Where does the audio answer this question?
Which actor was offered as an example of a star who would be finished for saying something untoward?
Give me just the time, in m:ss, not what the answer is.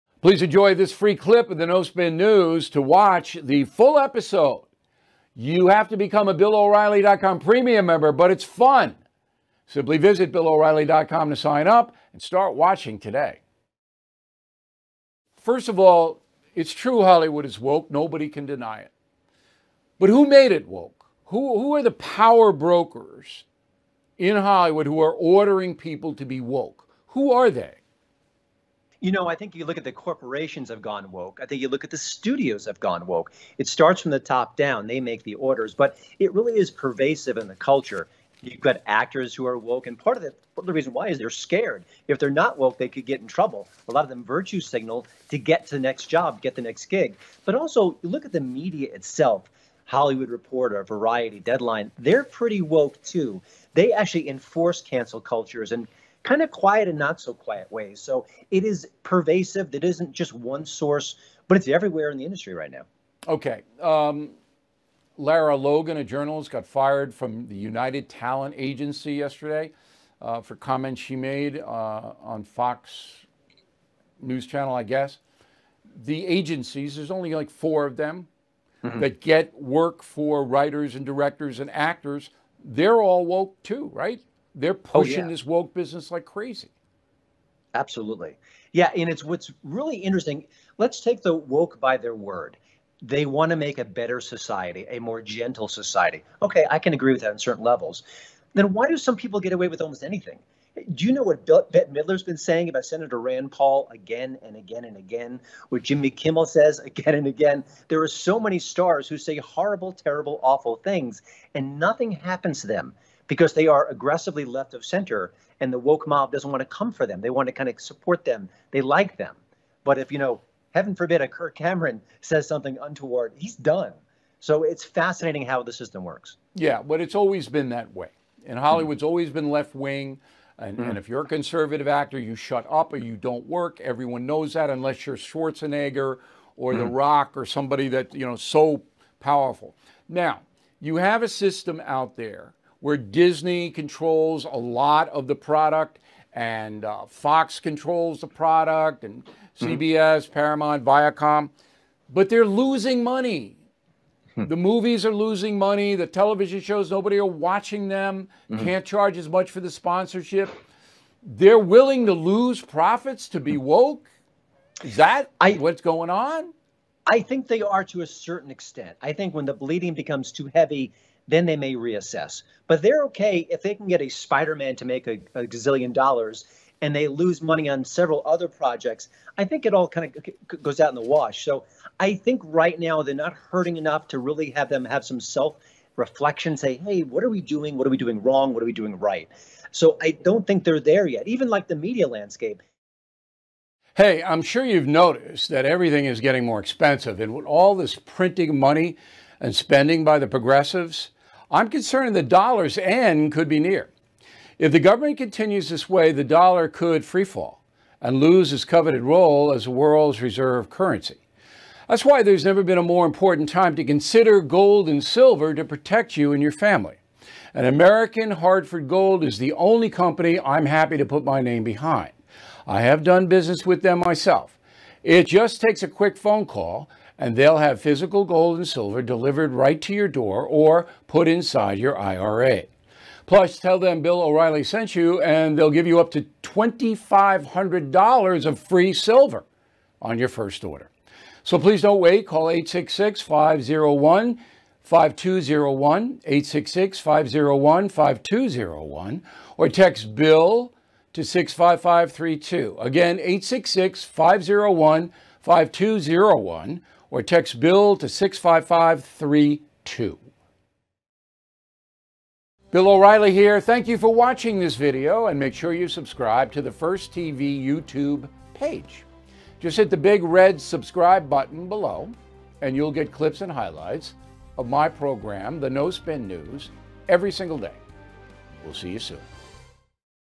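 2:01.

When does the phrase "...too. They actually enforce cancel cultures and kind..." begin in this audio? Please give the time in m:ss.
0:53.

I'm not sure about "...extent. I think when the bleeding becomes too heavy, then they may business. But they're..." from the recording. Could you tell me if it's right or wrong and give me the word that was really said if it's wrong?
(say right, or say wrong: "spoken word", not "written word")
wrong: "reassess", not "business".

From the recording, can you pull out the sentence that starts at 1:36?
Okay, I can agree with that on certain levels.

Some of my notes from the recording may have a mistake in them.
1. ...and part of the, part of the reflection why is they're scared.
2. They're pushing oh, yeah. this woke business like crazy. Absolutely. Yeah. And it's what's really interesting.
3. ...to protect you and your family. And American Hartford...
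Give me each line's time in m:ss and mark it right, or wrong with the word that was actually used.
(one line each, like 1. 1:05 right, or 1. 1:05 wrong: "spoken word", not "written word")
1. 0:39 wrong: "reason", not "reflection"
2. 1:24 right
3. 3:35 right.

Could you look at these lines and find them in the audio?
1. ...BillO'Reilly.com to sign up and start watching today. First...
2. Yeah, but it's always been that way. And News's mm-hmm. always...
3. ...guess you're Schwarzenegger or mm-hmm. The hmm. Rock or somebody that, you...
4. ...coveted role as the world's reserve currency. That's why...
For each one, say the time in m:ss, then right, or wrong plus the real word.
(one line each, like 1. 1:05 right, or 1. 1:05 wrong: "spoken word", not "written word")
1. 0:10 right
2. 2:06 wrong: "Hollywood", not "News"
3. 2:14 wrong: "unless", not "guess"
4. 3:28 right.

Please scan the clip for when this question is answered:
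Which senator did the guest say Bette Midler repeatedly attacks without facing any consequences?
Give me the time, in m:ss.
1:43.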